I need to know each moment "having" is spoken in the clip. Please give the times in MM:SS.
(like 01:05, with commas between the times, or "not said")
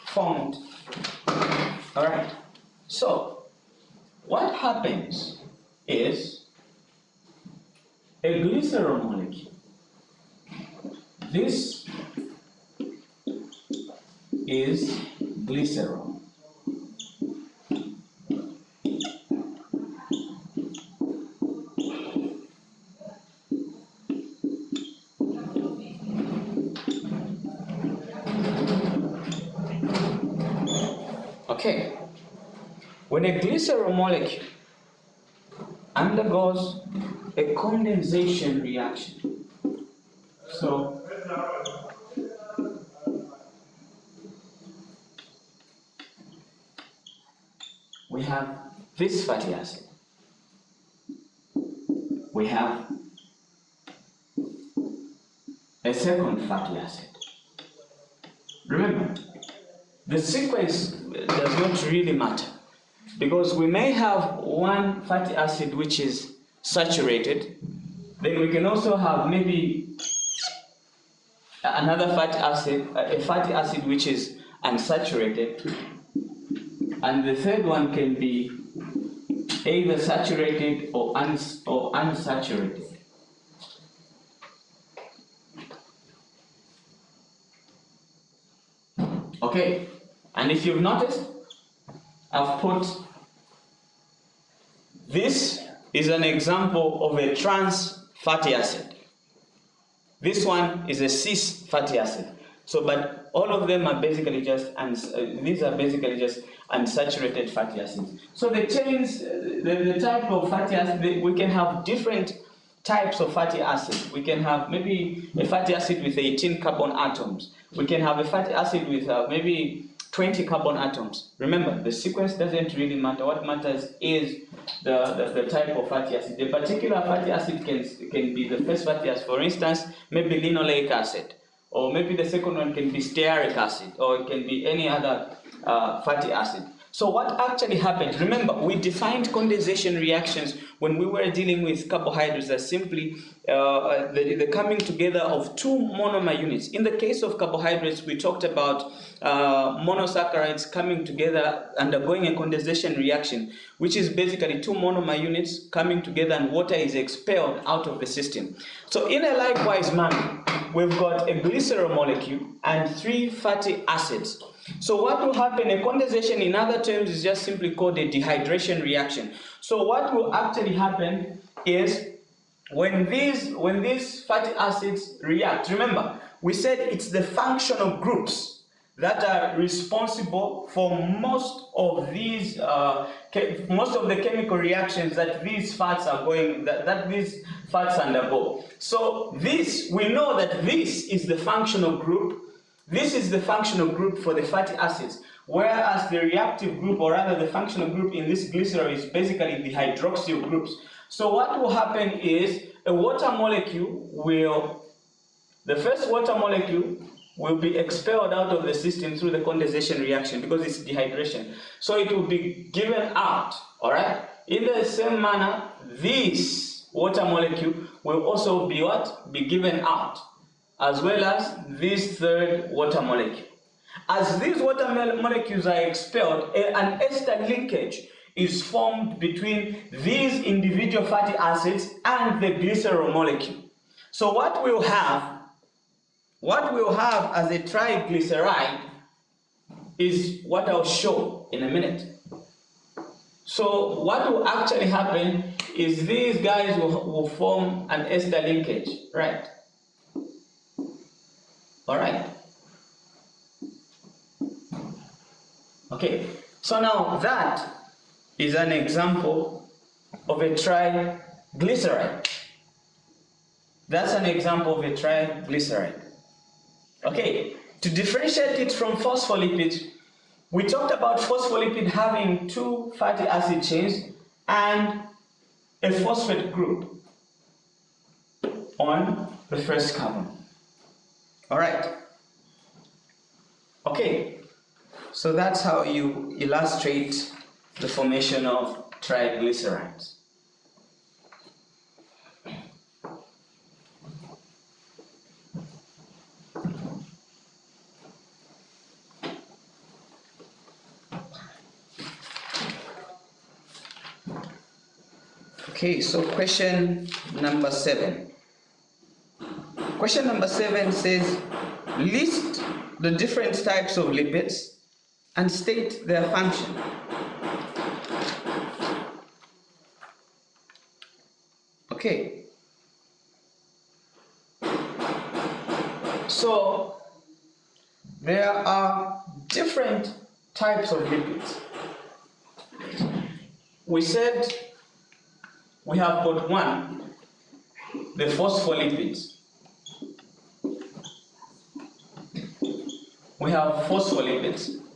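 04:31.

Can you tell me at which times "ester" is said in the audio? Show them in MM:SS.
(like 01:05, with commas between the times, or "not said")
03:47, 04:08.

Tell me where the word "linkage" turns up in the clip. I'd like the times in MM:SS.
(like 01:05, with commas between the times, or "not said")
03:47, 04:08.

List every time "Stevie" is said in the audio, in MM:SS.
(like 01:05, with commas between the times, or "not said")
not said.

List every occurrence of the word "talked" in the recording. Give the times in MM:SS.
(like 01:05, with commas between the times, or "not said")
02:28, 04:30.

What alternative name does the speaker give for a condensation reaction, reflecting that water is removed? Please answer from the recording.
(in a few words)
Dehydration reaction.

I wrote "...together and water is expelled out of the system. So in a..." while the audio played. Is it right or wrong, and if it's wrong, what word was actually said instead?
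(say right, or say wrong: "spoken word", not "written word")
right.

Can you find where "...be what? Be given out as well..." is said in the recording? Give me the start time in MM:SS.
03:38.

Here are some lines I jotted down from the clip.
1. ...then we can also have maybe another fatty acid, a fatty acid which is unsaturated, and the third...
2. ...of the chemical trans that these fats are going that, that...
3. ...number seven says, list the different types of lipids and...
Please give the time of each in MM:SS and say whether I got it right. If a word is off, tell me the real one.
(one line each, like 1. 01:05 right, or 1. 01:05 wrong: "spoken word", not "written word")
1. 01:08 right
2. 03:03 wrong: "reactions", not "trans"
3. 05:10 right.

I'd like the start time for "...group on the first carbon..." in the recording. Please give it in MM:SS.
04:36.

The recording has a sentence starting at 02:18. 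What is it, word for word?
Remember, we defined condensation reactions when we were dealing with carbohydrates as simply uh, the, the, coming together of two monomer units.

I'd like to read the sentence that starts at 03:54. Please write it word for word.
So what we'll have, what we'll have as a triglyceride is what I'll show in a minute.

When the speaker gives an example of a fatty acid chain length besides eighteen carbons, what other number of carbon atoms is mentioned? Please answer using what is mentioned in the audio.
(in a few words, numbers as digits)
20.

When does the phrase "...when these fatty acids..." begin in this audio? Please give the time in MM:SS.
02:53.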